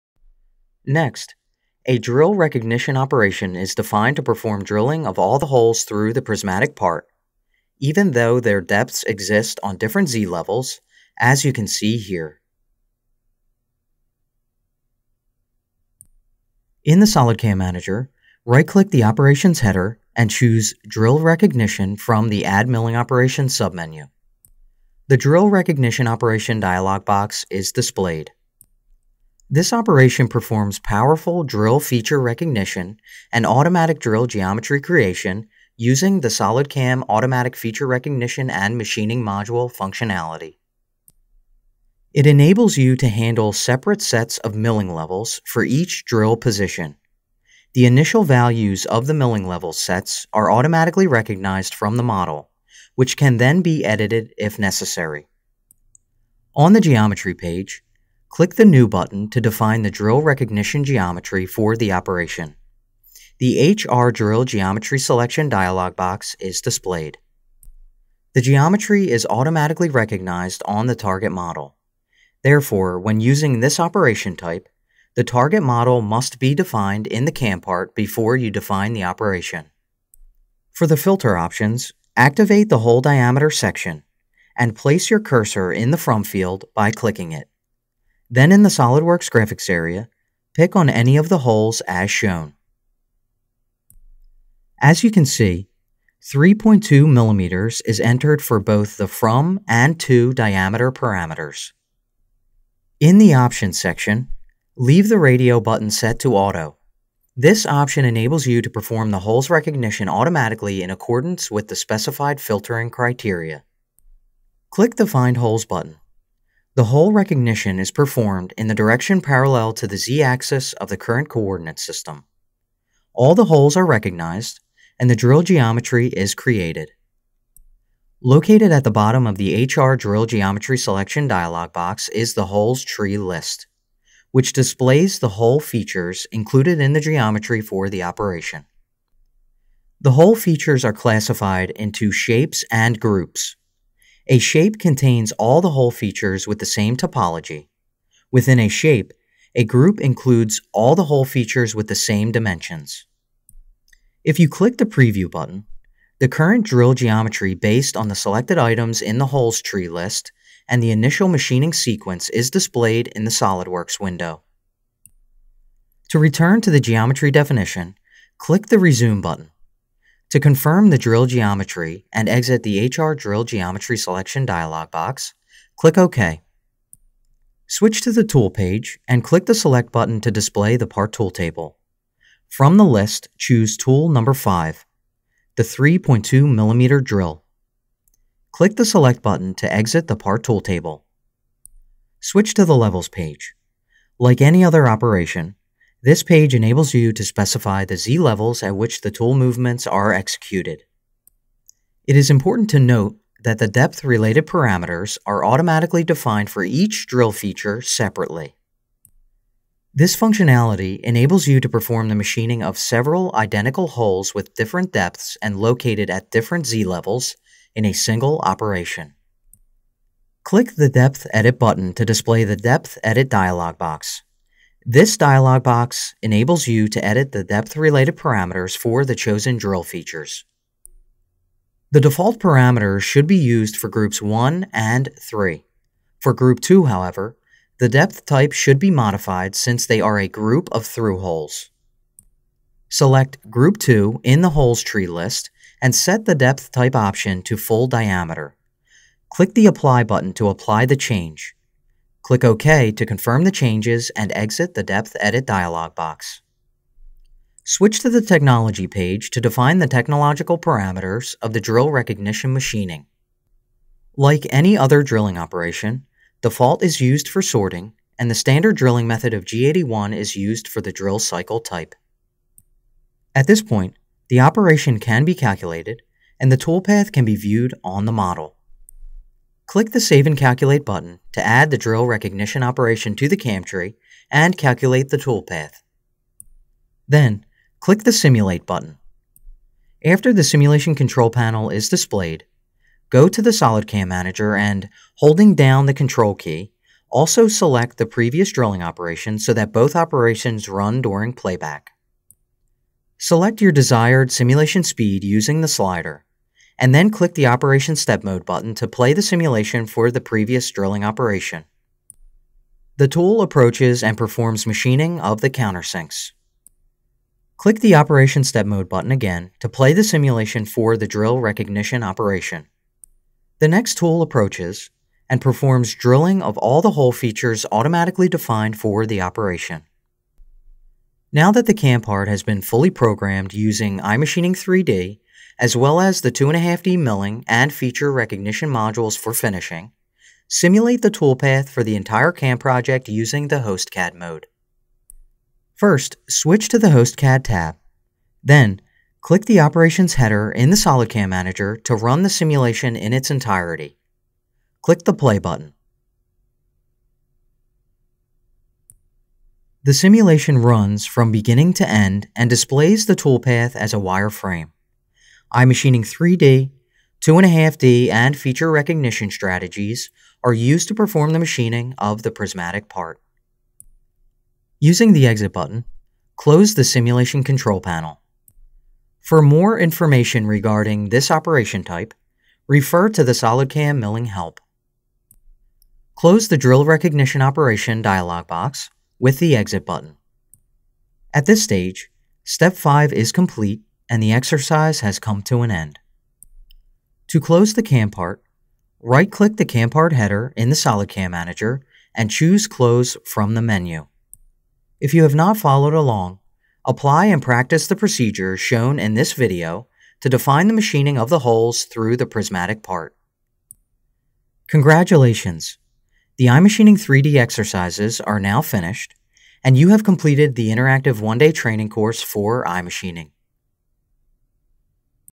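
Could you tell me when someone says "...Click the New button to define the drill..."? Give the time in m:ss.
0:58.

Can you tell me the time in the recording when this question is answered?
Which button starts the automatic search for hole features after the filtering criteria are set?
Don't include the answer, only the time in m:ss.
1:55.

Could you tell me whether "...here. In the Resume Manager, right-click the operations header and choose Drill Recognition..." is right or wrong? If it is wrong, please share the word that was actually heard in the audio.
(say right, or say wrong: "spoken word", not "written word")
wrong: "SolidCAM", not "Resume".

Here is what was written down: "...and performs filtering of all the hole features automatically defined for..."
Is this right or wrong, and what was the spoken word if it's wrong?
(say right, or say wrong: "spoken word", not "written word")
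wrong: "drilling", not "filtering".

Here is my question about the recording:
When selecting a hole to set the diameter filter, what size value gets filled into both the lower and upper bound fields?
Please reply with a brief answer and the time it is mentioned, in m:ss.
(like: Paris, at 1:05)
3.2 millimeters, at 1:36.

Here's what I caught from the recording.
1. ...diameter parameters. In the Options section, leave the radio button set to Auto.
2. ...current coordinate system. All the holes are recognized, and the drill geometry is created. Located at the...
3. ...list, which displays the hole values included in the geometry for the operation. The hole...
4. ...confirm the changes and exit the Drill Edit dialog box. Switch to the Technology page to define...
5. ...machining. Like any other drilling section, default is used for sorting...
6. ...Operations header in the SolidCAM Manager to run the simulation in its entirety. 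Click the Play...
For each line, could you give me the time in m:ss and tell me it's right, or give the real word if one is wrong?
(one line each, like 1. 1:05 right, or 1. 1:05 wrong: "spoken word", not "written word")
1. 1:40 right
2. 2:00 right
3. 2:13 wrong: "features", not "values"
4. 4:13 wrong: "Depth", not "Drill"
5. 4:22 wrong: "operation", not "section"
6. 5:49 right.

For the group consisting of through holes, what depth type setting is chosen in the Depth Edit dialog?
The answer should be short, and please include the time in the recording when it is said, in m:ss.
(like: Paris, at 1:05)
full diameter, at 4:07.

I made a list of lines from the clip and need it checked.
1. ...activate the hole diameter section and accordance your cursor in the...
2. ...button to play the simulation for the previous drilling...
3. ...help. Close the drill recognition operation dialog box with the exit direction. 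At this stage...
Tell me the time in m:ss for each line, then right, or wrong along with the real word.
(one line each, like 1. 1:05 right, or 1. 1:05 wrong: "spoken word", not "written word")
1. 1:22 wrong: "place", not "accordance"
2. 5:08 right
3. 6:24 wrong: "button", not "direction".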